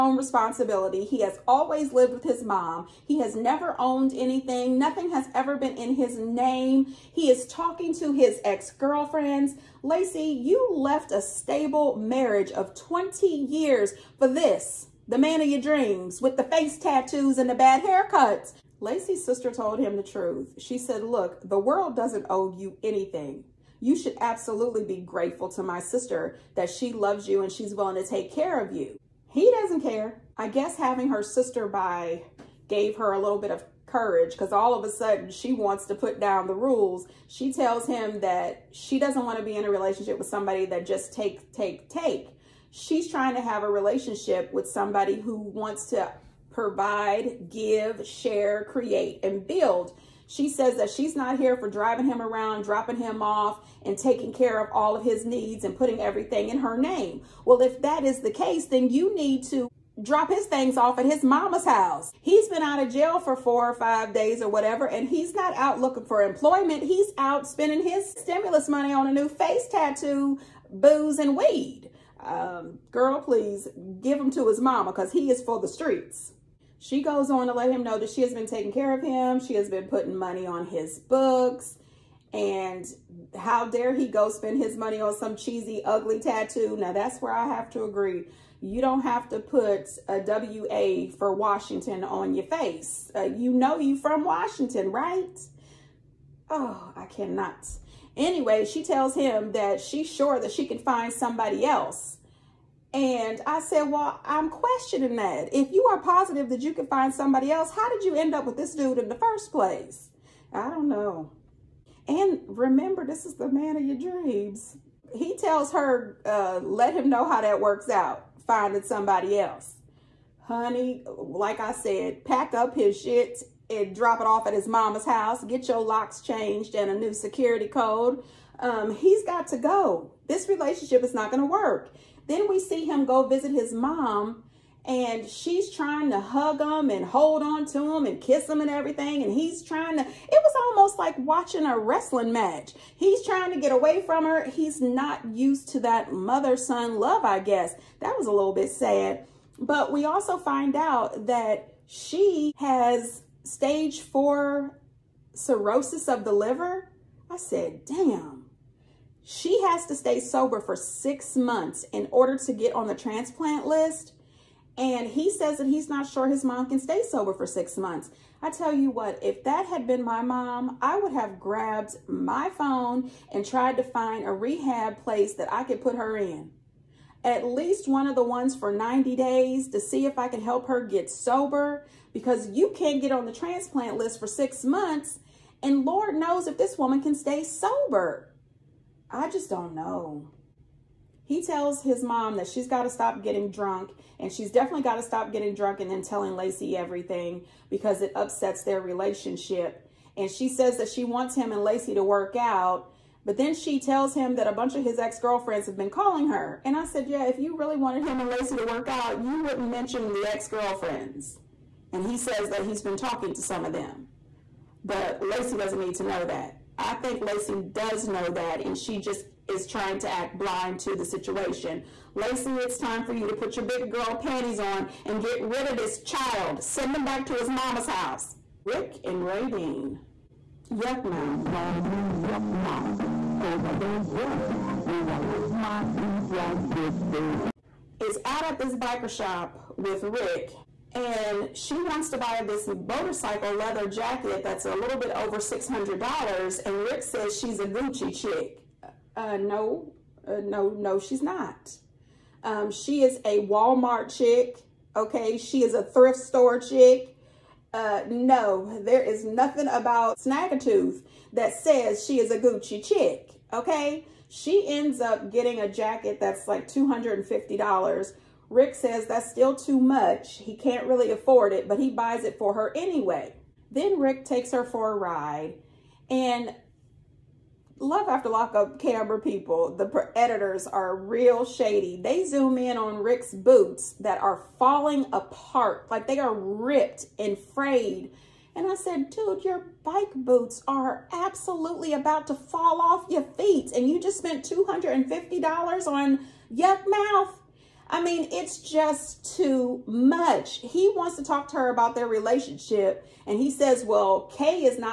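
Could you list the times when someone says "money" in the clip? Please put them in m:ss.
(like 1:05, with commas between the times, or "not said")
1:08, 1:20, 1:24.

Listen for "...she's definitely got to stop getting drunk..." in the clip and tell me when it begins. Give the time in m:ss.
3:14.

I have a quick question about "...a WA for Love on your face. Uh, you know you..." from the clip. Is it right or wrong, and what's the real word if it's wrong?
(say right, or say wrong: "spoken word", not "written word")
wrong: "Washington", not "Love".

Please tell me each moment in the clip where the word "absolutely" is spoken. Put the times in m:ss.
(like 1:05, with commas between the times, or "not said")
0:24, 4:51.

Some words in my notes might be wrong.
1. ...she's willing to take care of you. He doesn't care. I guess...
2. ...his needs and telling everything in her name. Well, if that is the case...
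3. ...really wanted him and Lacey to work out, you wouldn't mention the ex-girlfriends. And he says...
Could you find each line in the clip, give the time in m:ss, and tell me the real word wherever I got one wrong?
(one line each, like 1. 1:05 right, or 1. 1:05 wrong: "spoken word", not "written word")
1. 0:27 right
2. 0:55 wrong: "putting", not "telling"
3. 3:27 right.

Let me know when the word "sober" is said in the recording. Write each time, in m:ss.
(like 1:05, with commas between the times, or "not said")
2:40, 2:47, 3:01, 3:07.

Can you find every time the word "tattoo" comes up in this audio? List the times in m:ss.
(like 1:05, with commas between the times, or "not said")
0:16, 1:09, 1:26.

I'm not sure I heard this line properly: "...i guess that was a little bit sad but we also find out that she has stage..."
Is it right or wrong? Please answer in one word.
right.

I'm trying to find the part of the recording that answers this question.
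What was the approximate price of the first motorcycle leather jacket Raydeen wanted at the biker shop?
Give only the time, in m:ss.
4:04.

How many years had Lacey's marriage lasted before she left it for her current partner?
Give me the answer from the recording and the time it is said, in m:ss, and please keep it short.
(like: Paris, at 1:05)
20 years, at 0:12.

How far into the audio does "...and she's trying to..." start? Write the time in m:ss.
2:14.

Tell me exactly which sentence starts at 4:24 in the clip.
She ends up getting a jacket that's like $250 Rick says that's still too much.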